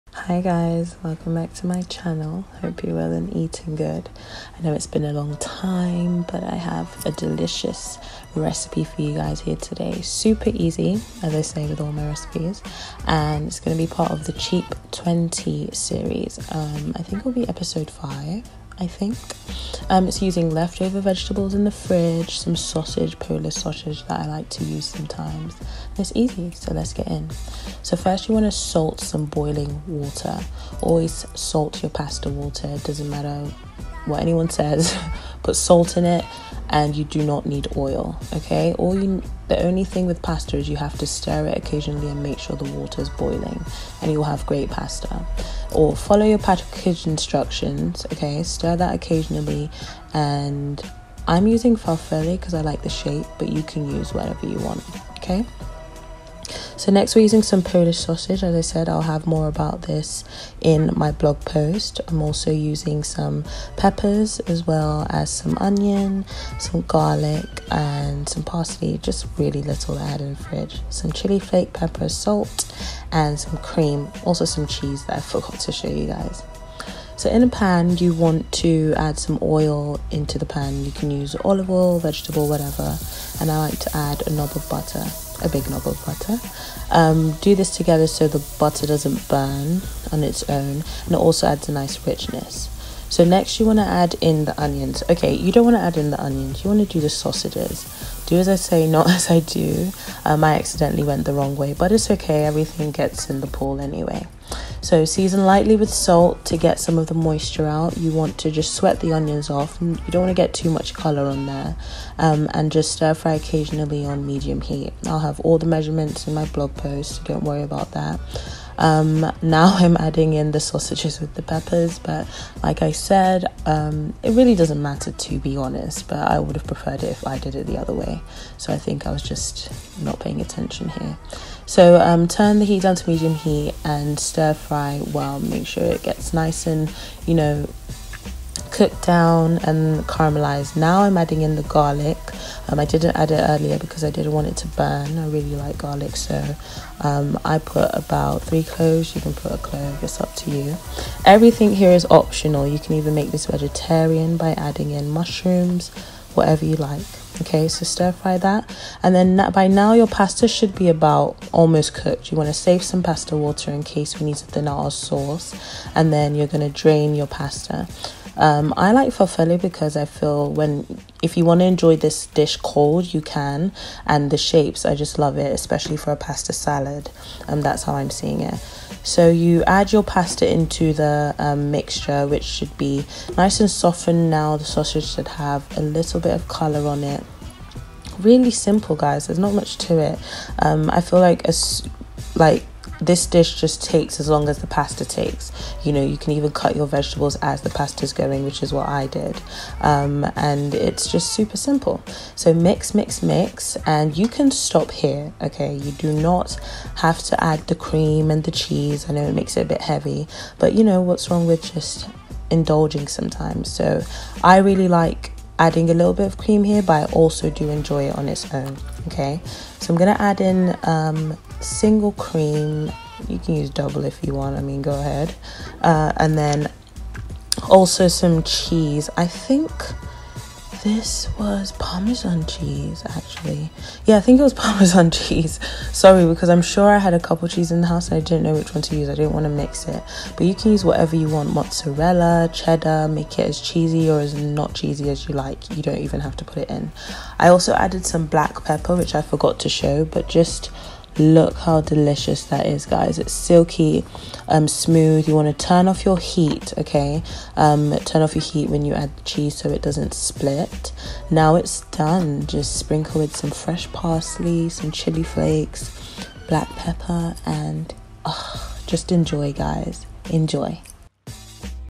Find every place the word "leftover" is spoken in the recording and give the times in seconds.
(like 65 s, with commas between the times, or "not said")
20 s.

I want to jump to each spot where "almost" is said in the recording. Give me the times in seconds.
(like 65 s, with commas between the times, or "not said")
161 s.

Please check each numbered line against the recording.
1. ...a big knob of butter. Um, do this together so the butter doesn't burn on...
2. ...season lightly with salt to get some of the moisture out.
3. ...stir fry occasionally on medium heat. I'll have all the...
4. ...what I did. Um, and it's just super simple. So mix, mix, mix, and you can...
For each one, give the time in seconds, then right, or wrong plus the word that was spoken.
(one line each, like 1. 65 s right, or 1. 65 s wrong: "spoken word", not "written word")
1. 85 s right
2. 105 s right
3. 112 s right
4. 198 s right.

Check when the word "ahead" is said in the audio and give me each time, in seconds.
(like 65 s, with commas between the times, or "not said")
224 s.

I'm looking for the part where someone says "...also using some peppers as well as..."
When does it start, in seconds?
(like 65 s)
62 s.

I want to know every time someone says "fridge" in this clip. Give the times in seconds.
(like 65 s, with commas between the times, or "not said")
21 s, 70 s.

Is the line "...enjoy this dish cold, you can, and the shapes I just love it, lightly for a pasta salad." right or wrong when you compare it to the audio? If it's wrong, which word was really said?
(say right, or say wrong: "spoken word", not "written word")
wrong: "especially", not "lightly".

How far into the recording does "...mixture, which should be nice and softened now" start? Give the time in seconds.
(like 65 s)
181 s.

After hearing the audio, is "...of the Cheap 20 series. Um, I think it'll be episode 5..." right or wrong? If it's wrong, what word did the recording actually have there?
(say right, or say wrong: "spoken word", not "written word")
right.